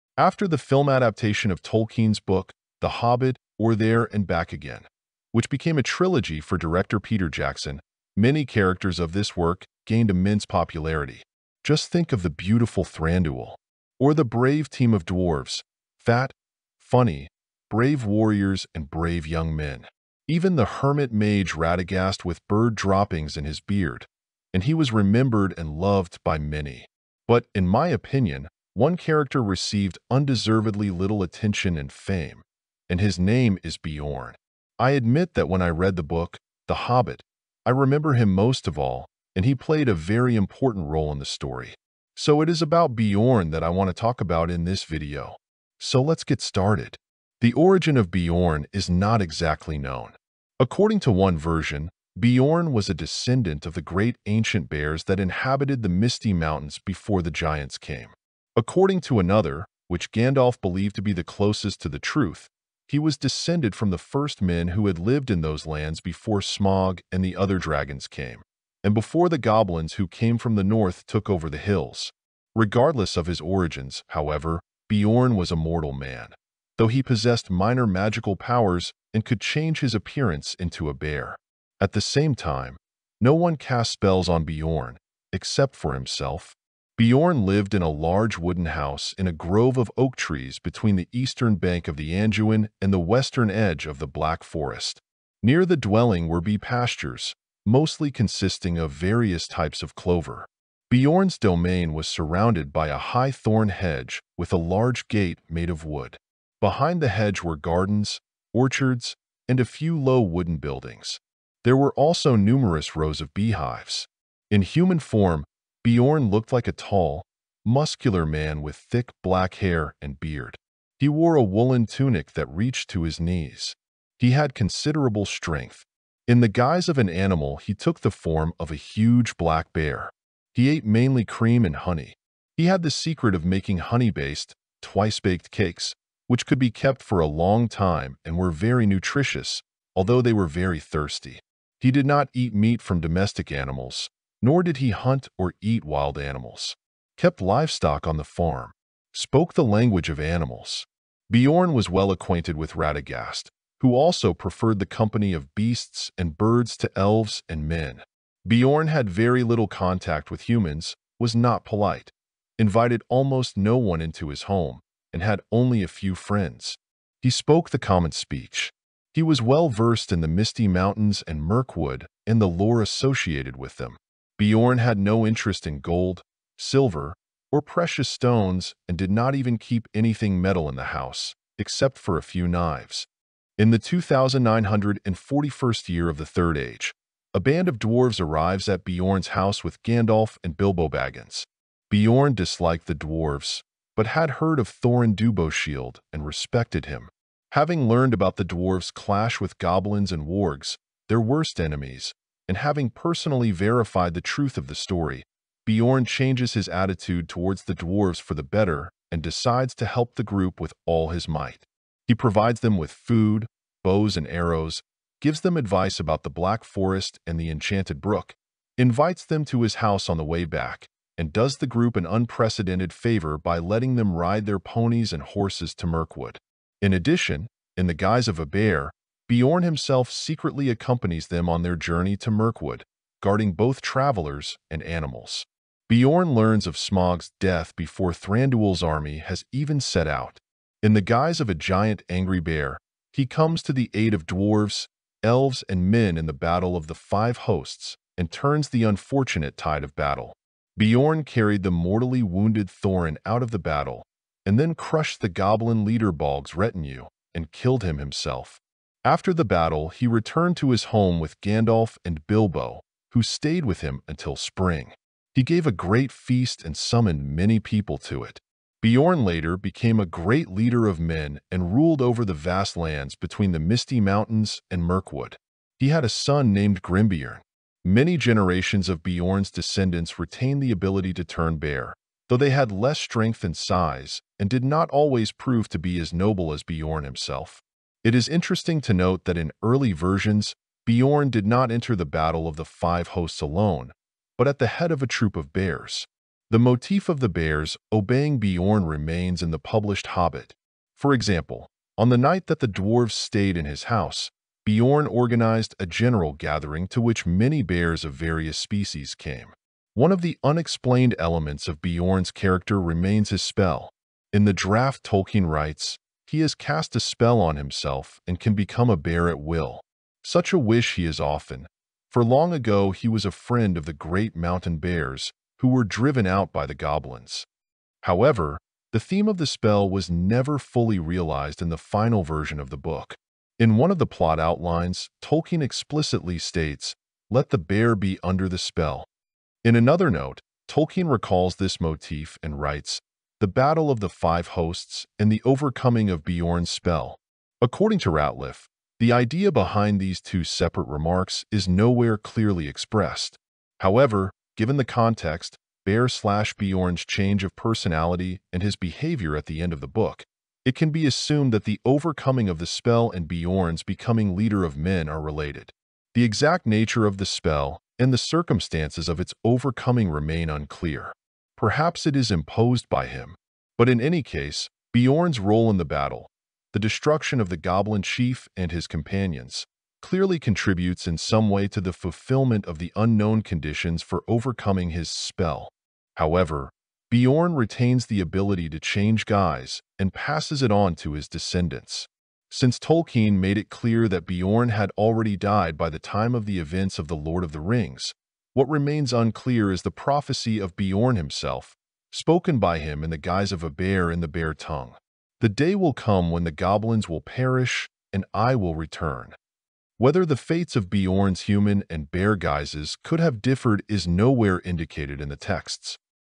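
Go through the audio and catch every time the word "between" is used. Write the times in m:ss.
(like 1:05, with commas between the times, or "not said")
1:30, 4:33.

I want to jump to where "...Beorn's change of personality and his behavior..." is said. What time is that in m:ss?
5:56.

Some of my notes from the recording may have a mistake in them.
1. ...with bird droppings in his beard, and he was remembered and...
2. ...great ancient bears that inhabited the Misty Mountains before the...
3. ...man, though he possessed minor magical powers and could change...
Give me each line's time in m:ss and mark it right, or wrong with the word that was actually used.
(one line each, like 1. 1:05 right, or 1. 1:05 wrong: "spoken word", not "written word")
1. 0:22 right
2. 0:53 right
3. 1:15 right.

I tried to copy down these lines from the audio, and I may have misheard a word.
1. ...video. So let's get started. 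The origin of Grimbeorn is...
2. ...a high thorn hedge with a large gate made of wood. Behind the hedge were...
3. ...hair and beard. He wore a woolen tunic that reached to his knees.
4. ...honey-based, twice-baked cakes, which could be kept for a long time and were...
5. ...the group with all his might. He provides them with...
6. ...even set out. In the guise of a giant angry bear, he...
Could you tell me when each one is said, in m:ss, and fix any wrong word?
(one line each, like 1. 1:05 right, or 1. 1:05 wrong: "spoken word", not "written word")
1. 0:44 wrong: "Beorn", not "Grimbeorn"
2. 1:42 right
3. 1:59 right
4. 2:13 right
5. 3:30 right
6. 3:59 right.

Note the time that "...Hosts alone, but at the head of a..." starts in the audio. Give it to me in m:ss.
4:53.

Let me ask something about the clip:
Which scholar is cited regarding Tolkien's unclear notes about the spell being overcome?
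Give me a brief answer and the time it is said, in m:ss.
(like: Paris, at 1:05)
Rateliff, at 5:48.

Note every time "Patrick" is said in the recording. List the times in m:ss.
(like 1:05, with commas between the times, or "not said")
not said.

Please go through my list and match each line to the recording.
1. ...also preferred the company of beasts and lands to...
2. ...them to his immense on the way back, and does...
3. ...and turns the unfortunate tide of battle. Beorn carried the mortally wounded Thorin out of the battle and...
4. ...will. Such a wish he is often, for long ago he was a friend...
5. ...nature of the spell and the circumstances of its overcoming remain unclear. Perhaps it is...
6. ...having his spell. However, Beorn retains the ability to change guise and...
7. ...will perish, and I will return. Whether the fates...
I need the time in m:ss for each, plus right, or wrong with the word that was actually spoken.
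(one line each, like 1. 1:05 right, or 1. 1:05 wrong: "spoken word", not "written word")
1. 2:33 wrong: "birds", not "lands"
2. 3:39 wrong: "house", not "immense"
3. 4:08 right
4. 5:19 right
5. 6:06 right
6. 6:24 wrong: "overcoming", not "having"
7. 6:47 right.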